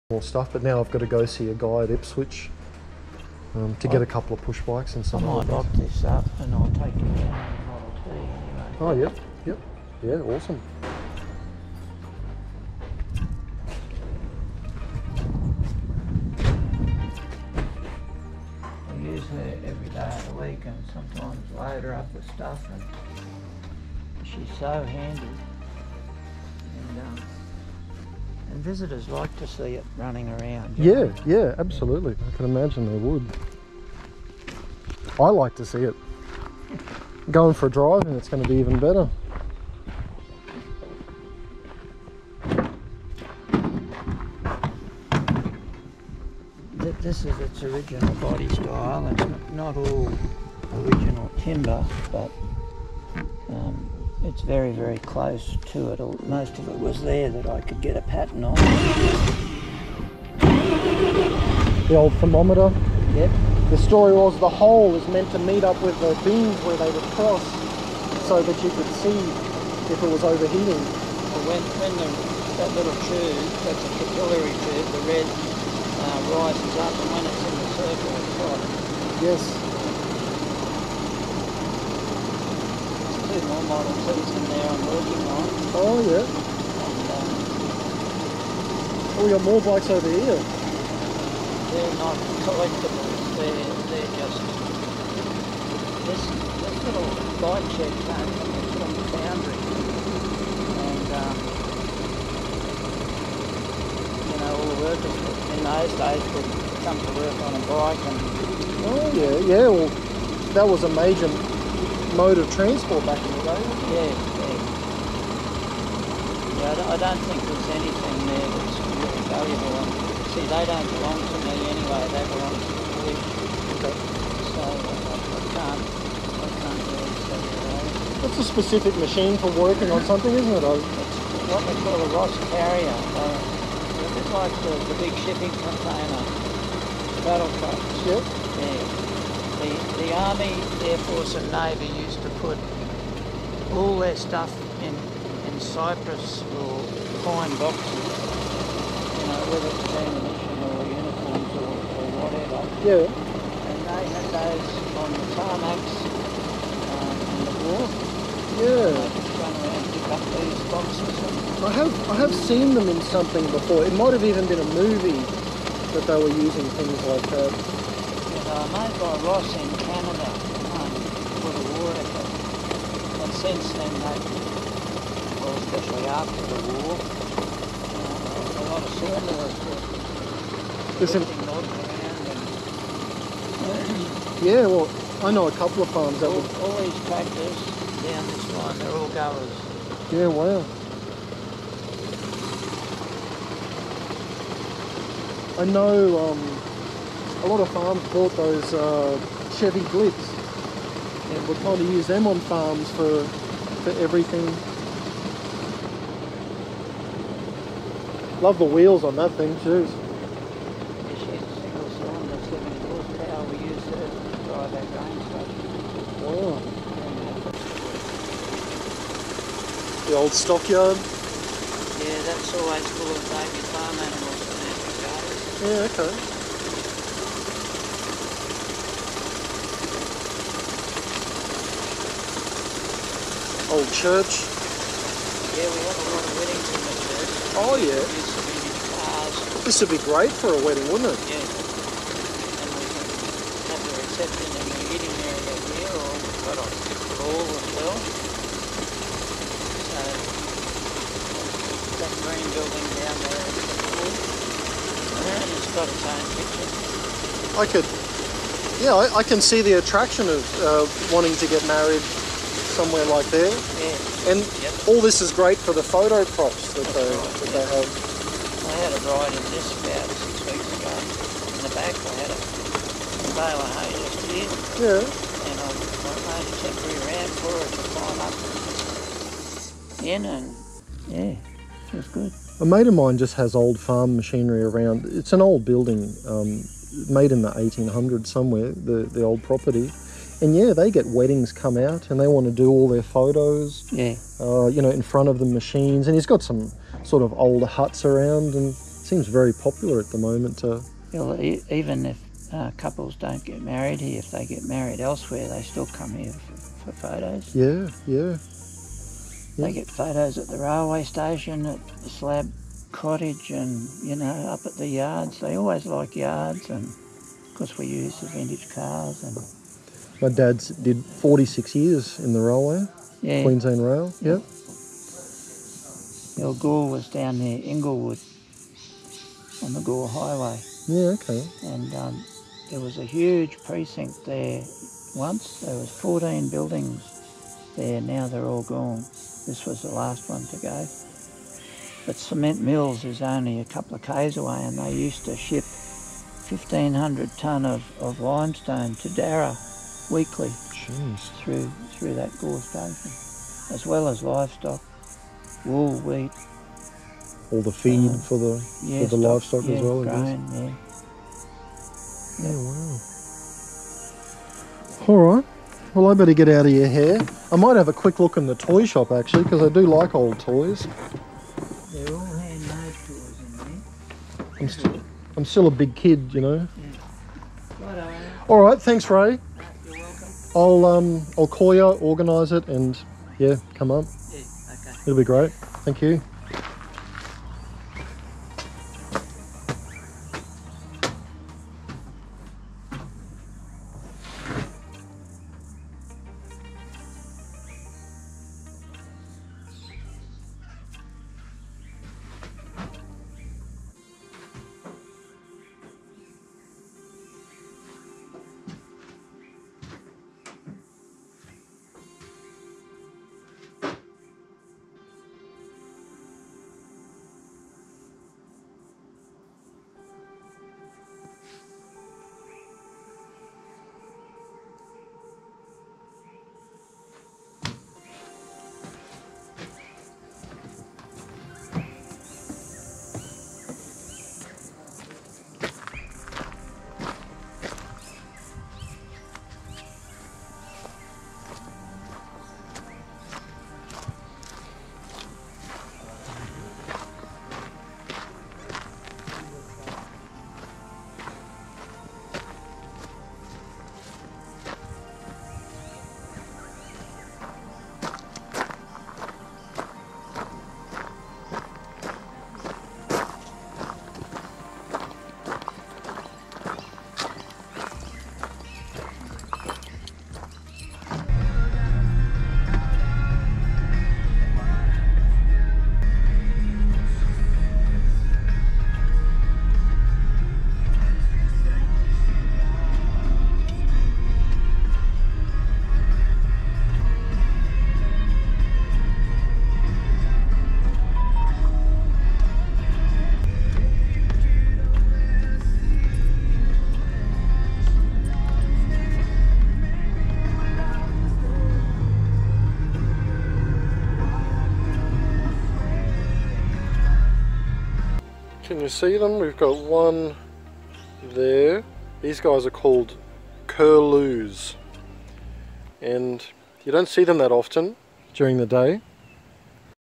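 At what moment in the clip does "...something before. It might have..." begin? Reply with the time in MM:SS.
02:43.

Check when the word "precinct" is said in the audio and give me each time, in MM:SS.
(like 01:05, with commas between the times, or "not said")
05:33.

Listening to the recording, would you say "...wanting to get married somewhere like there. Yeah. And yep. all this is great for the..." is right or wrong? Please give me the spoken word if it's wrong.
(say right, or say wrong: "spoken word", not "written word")
right.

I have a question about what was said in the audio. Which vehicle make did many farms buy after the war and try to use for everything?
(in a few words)
Chevy Blitz.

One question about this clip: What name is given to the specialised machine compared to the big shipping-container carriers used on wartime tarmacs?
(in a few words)
Ross carrier.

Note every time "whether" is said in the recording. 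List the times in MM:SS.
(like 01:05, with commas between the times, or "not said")
02:29.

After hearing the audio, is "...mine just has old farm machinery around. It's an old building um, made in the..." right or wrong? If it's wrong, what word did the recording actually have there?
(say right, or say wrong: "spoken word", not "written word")
right.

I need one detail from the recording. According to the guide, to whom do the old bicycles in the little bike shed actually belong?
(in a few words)
the police.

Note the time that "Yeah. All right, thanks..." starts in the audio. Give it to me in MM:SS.
06:16.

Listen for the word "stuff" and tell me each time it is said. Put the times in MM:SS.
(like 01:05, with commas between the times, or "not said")
00:00, 00:22, 02:24.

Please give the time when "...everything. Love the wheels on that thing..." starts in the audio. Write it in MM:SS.
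03:23.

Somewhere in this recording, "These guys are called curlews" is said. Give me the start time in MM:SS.
08:32.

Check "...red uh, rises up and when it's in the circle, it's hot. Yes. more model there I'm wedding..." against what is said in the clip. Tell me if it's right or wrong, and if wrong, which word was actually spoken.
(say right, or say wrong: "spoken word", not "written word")
wrong: "working", not "wedding".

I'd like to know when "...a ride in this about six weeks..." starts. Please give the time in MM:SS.
04:28.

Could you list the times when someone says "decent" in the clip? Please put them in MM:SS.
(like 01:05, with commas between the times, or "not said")
not said.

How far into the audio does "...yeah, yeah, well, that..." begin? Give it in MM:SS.
01:49.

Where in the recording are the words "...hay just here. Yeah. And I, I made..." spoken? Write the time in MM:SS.
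04:33.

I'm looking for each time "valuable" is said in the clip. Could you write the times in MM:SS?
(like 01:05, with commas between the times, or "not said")
01:59.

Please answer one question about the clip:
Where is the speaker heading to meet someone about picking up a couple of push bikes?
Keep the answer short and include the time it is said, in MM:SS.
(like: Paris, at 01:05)
Ipswich, at 00:01.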